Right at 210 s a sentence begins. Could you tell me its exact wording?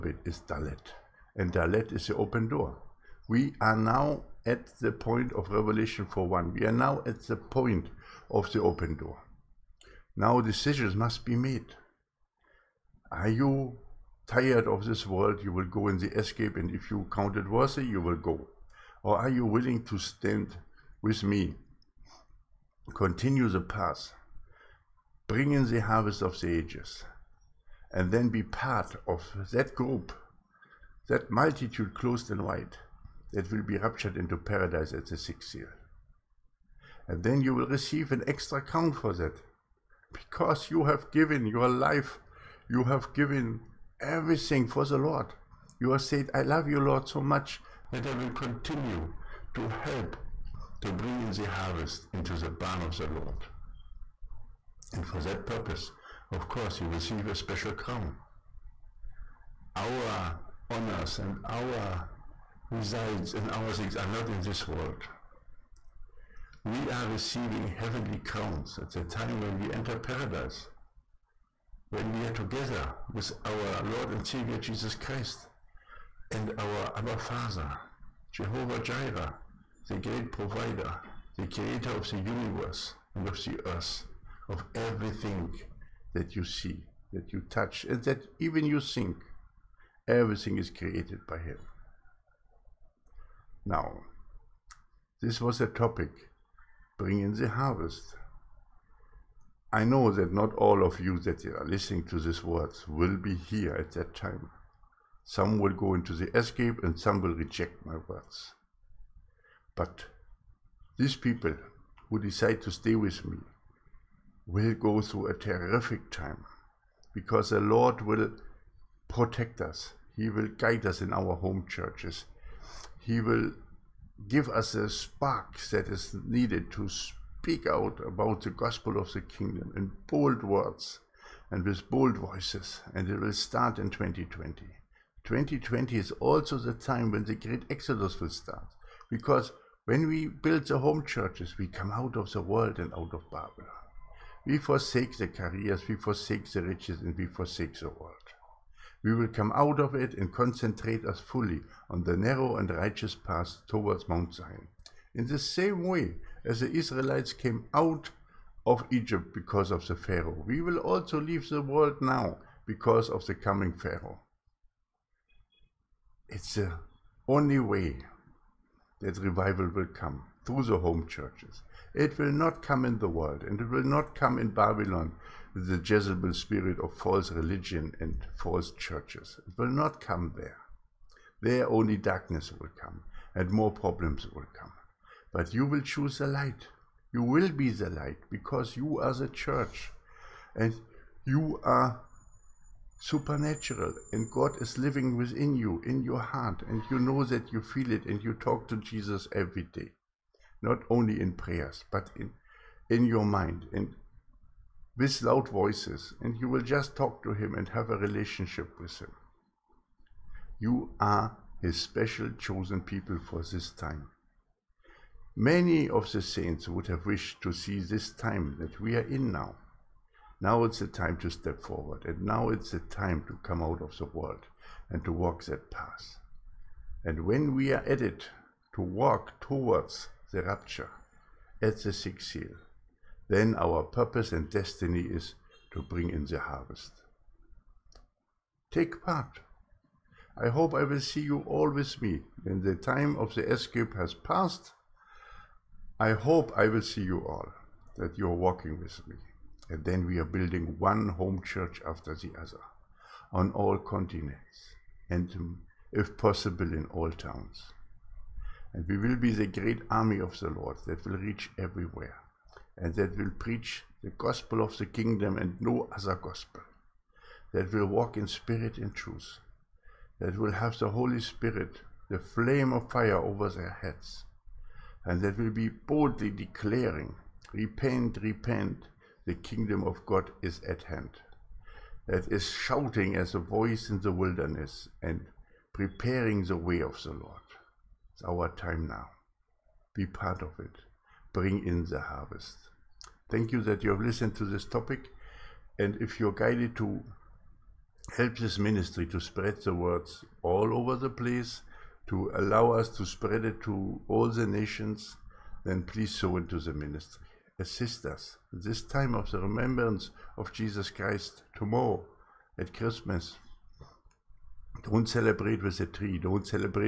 You are his special chosen people for this time.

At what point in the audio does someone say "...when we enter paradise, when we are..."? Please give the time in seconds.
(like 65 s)
69 s.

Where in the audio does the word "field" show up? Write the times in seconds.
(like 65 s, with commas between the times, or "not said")
not said.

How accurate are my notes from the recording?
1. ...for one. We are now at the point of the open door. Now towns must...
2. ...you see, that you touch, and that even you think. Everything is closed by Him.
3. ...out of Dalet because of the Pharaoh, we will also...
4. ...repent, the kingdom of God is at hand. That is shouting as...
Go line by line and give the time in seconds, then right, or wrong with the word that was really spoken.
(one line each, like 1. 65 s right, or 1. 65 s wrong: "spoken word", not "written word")
1. 6 s wrong: "decisions", not "towns"
2. 86 s wrong: "created", not "closed"
3. 157 s wrong: "Egypt", not "Dalet"
4. 278 s right.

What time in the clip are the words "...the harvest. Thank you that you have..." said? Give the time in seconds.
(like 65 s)
291 s.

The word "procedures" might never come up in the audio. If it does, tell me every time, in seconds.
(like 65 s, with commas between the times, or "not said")
not said.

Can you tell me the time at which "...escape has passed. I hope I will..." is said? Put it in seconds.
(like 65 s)
243 s.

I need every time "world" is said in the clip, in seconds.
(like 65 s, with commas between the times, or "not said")
15 s, 64 s, 142 s, 147 s, 161 s, 173 s, 224 s.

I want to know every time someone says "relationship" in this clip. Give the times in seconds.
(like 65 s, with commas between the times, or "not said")
207 s.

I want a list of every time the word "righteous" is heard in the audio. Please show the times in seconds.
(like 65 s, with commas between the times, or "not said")
152 s.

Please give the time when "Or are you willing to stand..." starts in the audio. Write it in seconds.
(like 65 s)
19 s.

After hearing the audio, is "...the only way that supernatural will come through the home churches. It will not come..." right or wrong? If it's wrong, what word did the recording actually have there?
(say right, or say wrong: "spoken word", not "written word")
wrong: "revival", not "supernatural".